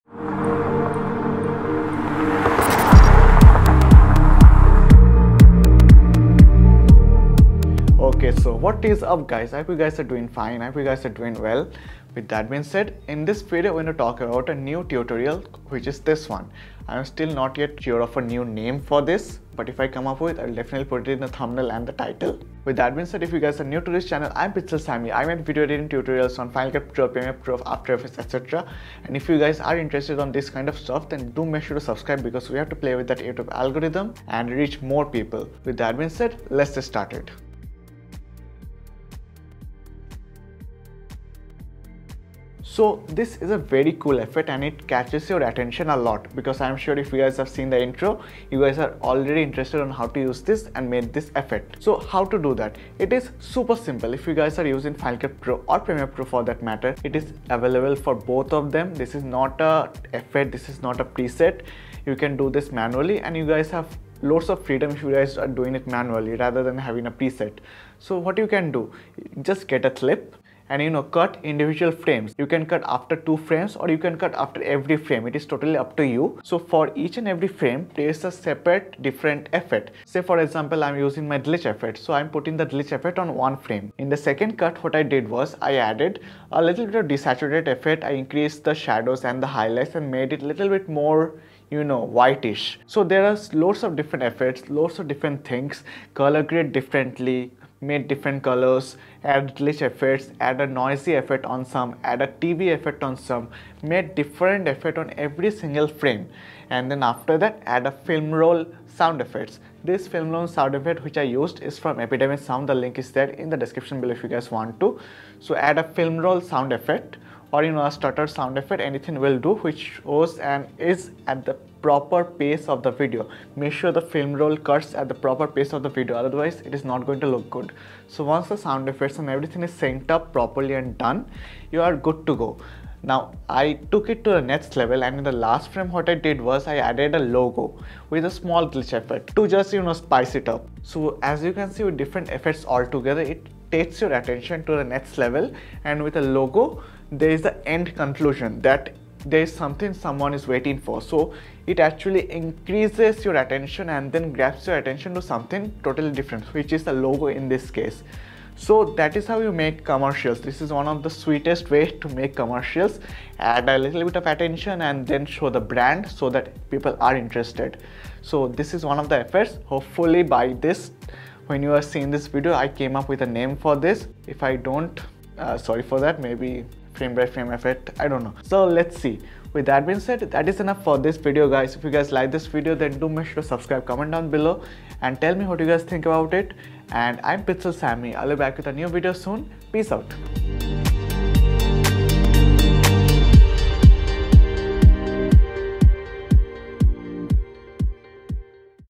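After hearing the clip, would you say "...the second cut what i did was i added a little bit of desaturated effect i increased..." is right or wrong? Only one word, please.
right.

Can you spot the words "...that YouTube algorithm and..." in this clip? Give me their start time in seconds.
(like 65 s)
33 s.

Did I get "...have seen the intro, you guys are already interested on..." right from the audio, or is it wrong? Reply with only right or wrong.
right.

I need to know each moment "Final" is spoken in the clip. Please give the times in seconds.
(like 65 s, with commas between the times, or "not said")
26 s, 54 s.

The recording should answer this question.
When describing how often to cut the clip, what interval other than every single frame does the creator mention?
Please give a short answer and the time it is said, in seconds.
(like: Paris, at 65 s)
2 frames, at 73 s.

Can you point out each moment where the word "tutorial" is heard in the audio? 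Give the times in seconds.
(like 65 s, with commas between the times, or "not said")
14 s, 25 s.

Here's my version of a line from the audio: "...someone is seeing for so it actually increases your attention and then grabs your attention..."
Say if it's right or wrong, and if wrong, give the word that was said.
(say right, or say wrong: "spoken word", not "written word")
wrong: "waiting", not "seeing".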